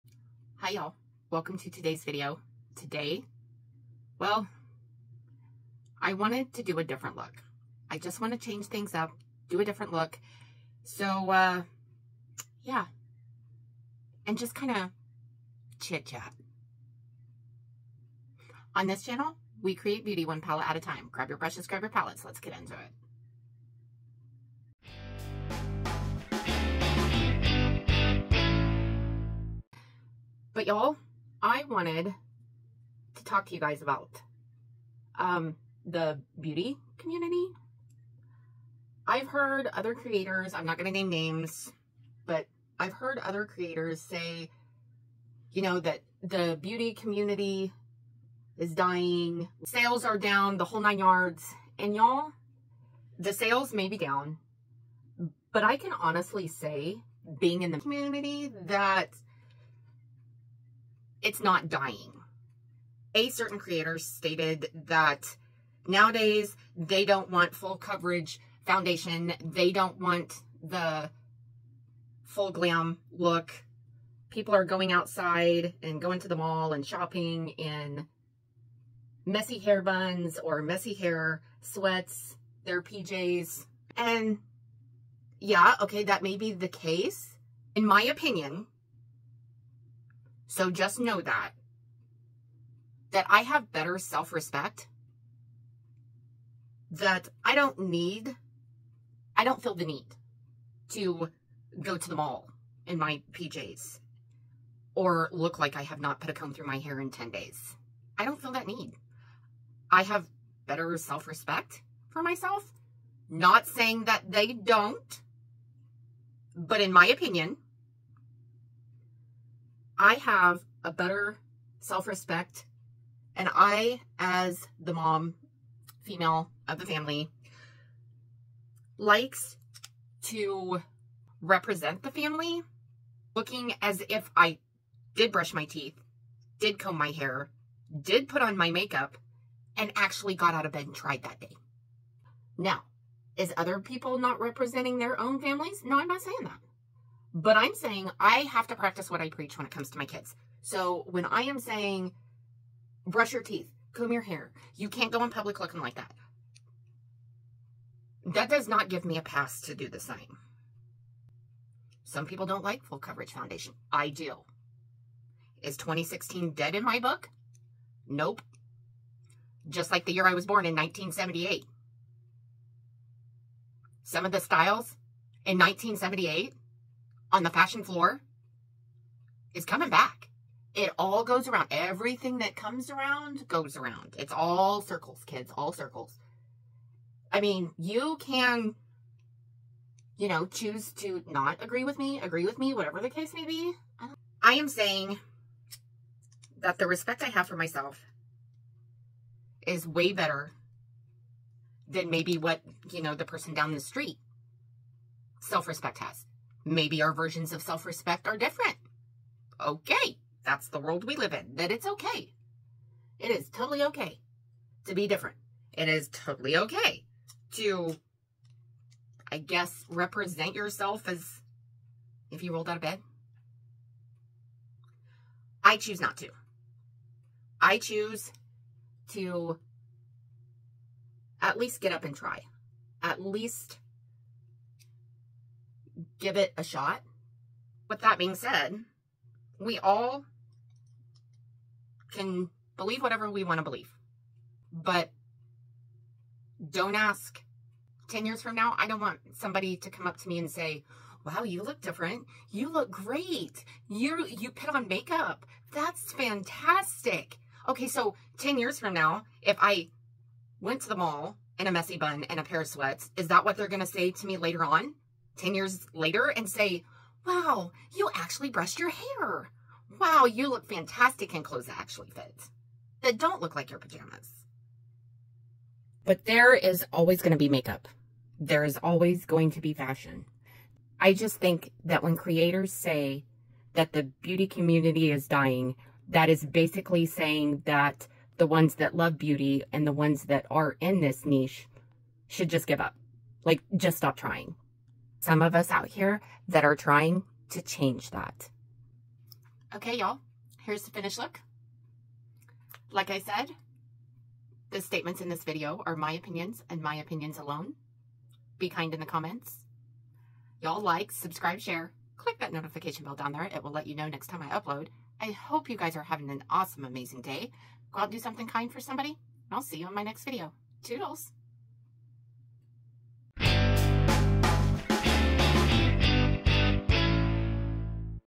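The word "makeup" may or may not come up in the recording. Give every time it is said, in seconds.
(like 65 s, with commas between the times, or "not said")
138 s, 254 s, 277 s.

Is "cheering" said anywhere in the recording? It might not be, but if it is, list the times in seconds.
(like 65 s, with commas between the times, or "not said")
not said.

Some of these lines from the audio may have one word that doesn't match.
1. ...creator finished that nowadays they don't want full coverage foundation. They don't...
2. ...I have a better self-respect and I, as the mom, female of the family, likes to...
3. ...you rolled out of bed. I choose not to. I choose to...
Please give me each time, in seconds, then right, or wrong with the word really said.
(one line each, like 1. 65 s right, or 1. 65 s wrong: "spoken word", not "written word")
1. 63 s wrong: "stated", not "finished"
2. 120 s right
3. 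222 s right.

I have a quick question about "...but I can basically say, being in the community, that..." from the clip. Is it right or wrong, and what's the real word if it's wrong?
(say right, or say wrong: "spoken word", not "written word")
wrong: "honestly", not "basically".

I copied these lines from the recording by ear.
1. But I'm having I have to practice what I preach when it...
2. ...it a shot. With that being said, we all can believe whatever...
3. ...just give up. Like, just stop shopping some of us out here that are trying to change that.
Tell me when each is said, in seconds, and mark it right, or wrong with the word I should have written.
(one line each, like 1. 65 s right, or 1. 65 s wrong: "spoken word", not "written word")
1. 147 s wrong: "saying", not "having"
2. 236 s right
3. 292 s wrong: "trying", not "shopping".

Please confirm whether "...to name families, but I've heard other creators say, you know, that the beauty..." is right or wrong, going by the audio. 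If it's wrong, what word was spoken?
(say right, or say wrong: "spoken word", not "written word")
wrong: "names", not "families".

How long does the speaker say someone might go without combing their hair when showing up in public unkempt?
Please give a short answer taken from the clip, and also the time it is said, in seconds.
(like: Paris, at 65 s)
10 days, at 107 s.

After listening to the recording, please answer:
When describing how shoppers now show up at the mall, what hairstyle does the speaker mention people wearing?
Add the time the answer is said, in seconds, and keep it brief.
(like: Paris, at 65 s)
Messy hair buns, at 79 s.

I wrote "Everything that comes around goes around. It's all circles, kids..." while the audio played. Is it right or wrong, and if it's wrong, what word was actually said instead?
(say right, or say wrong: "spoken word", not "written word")
right.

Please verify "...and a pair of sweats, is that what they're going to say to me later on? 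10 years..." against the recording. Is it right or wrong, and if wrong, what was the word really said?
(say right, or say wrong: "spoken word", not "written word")
right.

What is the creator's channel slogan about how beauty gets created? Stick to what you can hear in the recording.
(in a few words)
One palette at a time.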